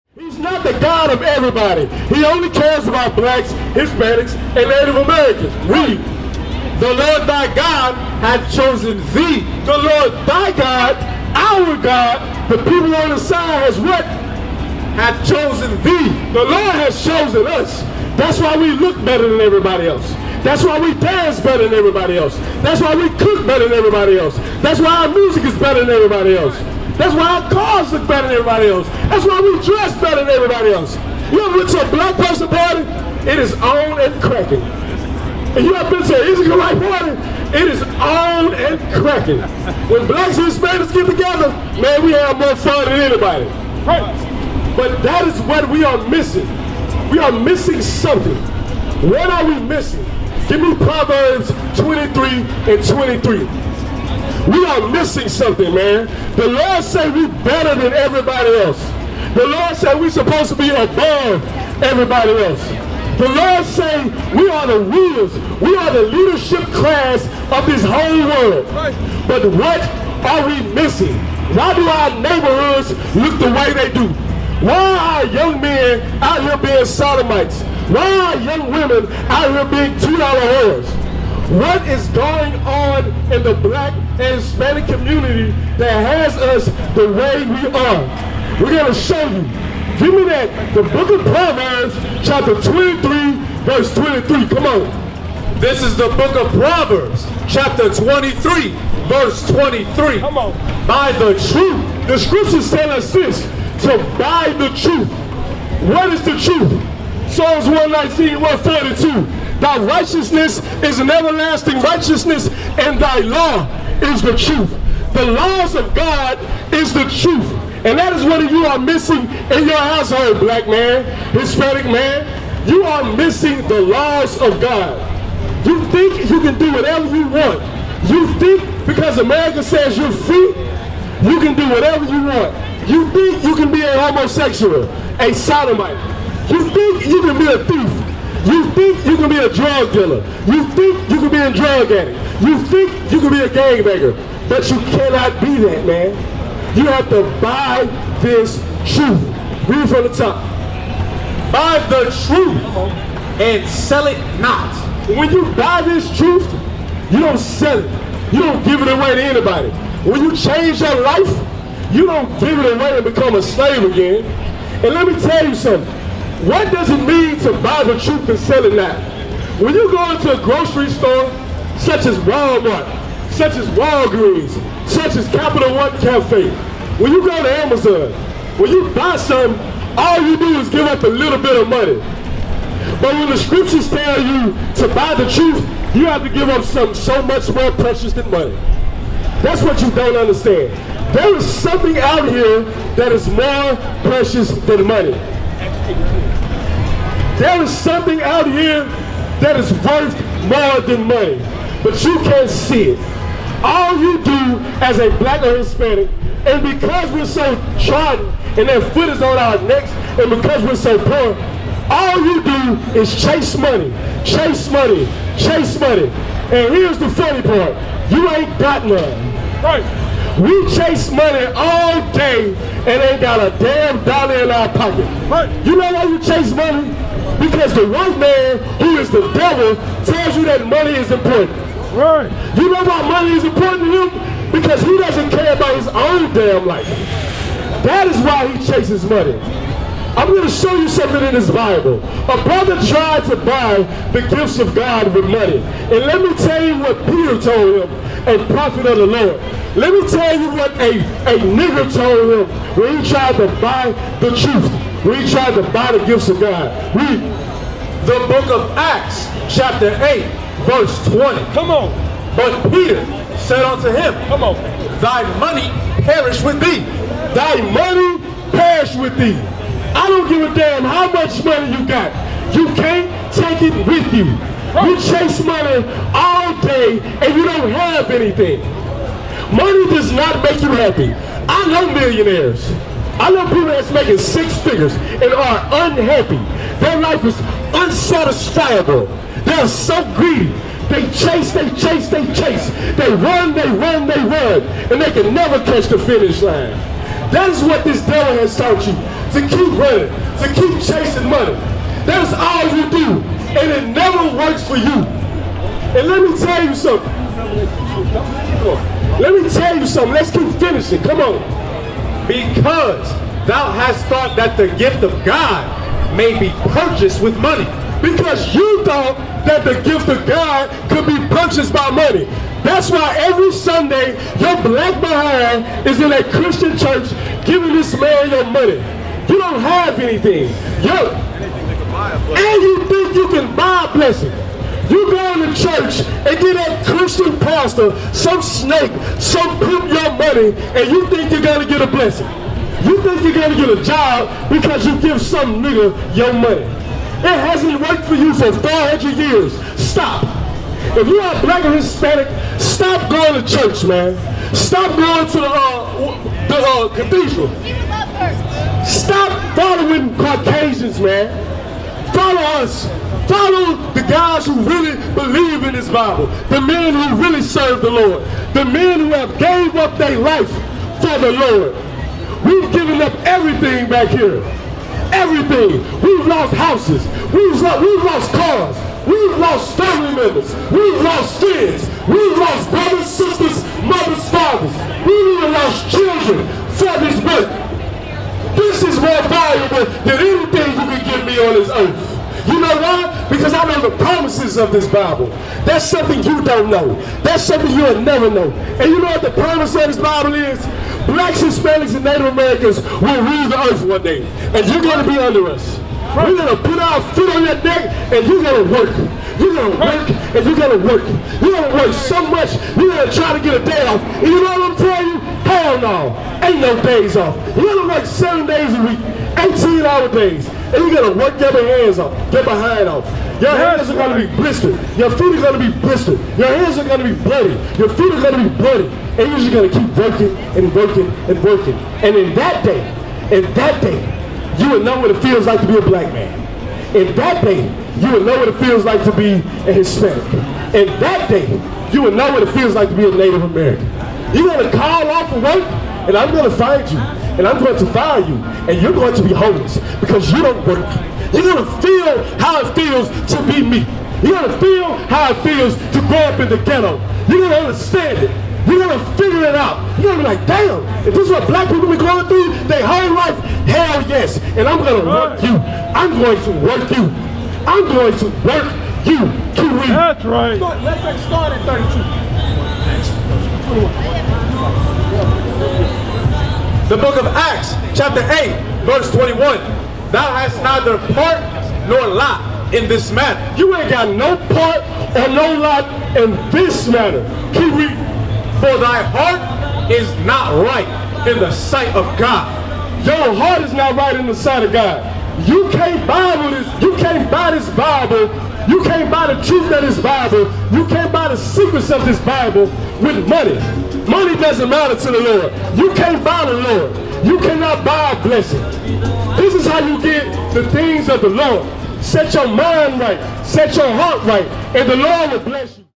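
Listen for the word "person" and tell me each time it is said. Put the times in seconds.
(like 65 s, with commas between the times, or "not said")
32 s.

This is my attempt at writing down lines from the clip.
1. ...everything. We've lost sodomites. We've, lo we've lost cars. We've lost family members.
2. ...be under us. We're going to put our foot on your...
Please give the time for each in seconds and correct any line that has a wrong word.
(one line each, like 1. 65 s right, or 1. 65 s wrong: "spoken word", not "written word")
1. 375 s wrong: "houses", not "sodomites"
2. 405 s right.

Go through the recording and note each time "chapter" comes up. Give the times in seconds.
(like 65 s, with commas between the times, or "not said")
92 s, 97 s, 259 s, 477 s.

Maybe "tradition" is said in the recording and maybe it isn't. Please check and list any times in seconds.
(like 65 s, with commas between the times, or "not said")
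not said.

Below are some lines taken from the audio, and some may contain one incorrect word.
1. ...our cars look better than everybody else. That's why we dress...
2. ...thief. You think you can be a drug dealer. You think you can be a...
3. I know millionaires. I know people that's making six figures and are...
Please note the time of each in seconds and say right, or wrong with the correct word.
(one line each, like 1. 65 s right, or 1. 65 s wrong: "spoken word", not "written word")
1. 27 s right
2. 137 s right
3. 281 s right.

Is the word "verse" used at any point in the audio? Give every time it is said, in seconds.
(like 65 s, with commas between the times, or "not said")
93 s, 99 s, 260 s, 478 s.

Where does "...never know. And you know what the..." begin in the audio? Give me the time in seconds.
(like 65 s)
398 s.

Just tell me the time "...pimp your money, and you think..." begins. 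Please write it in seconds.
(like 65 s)
339 s.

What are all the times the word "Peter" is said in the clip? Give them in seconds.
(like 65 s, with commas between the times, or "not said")
247 s, 262 s.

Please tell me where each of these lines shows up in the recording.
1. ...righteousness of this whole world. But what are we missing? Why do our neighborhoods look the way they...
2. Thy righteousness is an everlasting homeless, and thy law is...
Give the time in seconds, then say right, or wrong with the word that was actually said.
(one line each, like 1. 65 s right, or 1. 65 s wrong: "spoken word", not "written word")
1. 66 s wrong: "class", not "righteousness"
2. 109 s wrong: "righteousness", not "homeless".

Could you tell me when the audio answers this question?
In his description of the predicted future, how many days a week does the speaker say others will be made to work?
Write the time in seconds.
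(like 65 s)
418 s.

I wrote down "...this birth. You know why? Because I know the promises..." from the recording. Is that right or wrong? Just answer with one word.
wrong.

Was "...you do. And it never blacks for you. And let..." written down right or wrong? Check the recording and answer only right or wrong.
wrong.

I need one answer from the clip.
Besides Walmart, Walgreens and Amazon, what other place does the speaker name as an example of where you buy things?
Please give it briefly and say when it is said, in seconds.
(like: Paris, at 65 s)
Capital One Cafe, at 175 s.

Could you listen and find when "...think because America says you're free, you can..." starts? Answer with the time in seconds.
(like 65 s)
128 s.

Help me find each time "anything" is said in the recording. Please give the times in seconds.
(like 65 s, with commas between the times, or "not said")
278 s, 329 s, 390 s.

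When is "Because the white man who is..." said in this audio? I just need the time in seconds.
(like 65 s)
227 s.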